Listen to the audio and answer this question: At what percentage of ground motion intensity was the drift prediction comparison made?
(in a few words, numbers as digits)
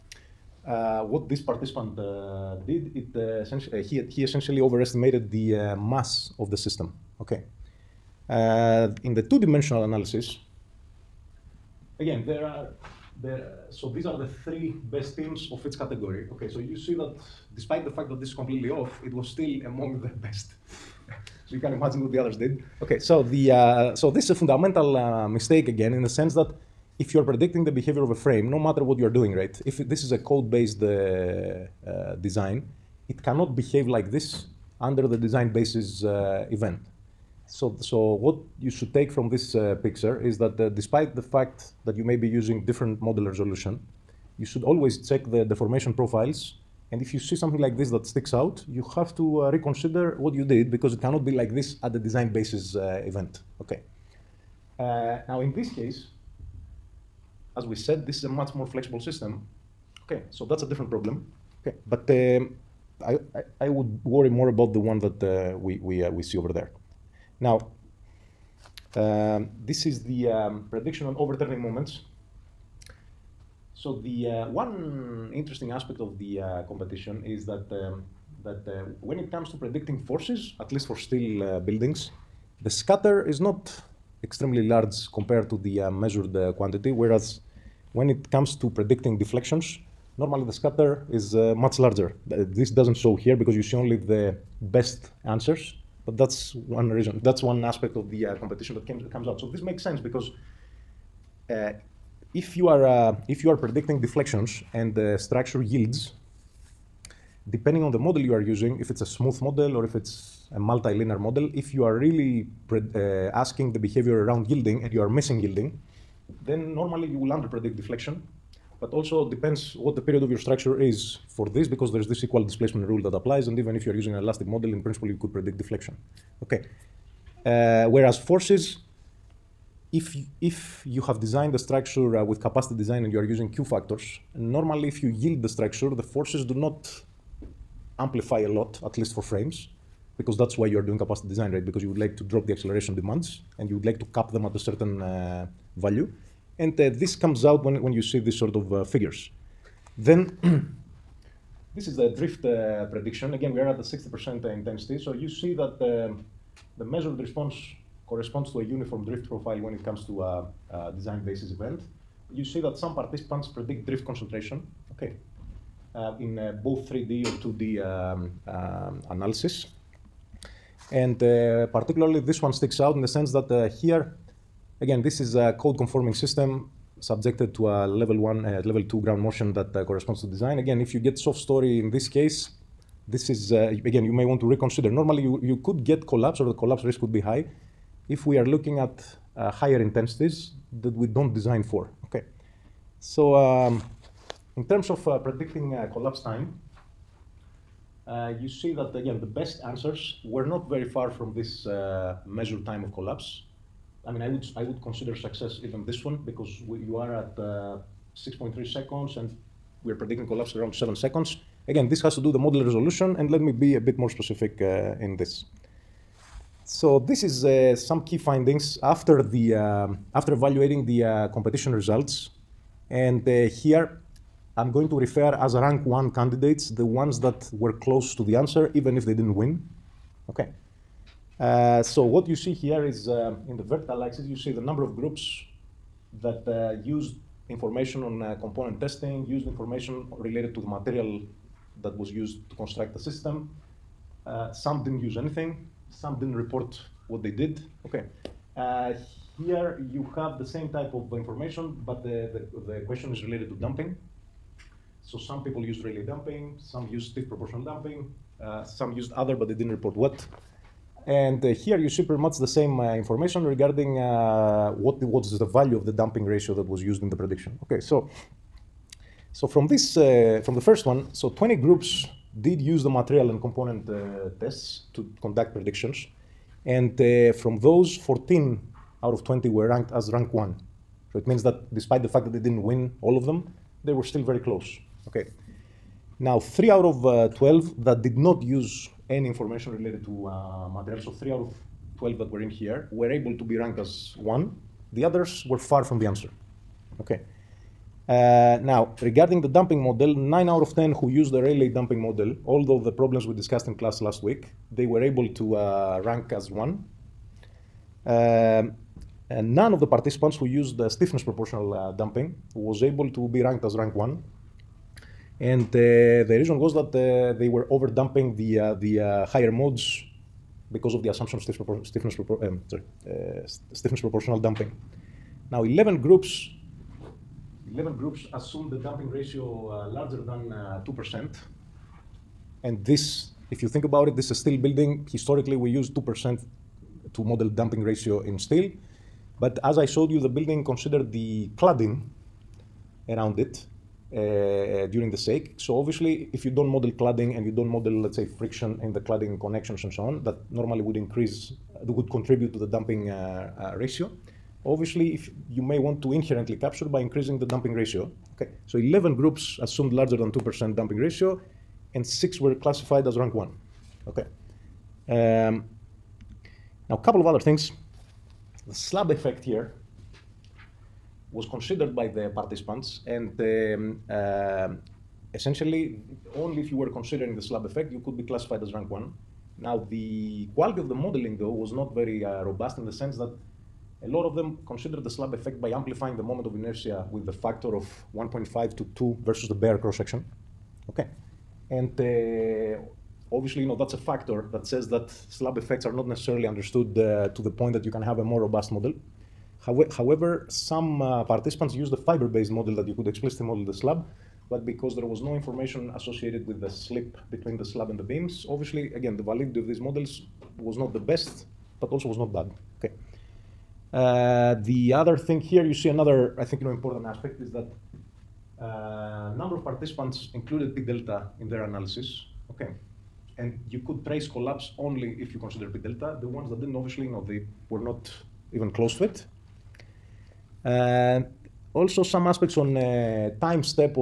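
60%.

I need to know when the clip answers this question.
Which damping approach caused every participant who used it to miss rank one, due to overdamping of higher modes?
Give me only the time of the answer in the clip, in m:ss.
5:10.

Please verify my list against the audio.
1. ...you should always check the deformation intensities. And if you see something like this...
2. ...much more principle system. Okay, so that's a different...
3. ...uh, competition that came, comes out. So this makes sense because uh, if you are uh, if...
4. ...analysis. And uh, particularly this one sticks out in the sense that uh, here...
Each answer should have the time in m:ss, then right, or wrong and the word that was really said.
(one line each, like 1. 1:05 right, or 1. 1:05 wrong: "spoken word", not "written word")
1. 0:44 wrong: "profiles", not "intensities"
2. 0:58 wrong: "flexible", not "principle"
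3. 1:38 right
4. 2:49 right.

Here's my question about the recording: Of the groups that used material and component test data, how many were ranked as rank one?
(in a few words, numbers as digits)
14.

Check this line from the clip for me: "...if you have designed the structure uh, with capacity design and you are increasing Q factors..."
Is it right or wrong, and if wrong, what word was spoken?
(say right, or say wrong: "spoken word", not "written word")
wrong: "using", not "increasing".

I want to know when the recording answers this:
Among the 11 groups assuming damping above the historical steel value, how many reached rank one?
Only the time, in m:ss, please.
6:02.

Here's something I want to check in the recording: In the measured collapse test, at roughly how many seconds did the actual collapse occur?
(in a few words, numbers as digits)
6.3 seconds.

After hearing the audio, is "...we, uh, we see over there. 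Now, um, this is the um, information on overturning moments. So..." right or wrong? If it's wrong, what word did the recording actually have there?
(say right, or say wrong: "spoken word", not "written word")
wrong: "prediction", not "information".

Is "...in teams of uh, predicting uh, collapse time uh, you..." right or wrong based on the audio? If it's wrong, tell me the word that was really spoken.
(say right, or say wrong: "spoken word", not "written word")
wrong: "terms", not "teams".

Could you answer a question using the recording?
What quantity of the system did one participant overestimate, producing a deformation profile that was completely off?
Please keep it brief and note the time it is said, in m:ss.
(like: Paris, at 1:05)
Mass, at 0:05.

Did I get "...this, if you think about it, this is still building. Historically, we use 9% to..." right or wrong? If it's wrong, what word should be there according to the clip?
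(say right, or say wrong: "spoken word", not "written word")
wrong: "2", not "9".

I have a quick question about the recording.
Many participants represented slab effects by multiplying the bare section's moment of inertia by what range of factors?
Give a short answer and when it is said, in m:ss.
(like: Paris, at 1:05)
1.5 to 2, at 6:28.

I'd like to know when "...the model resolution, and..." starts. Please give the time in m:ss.
3:32.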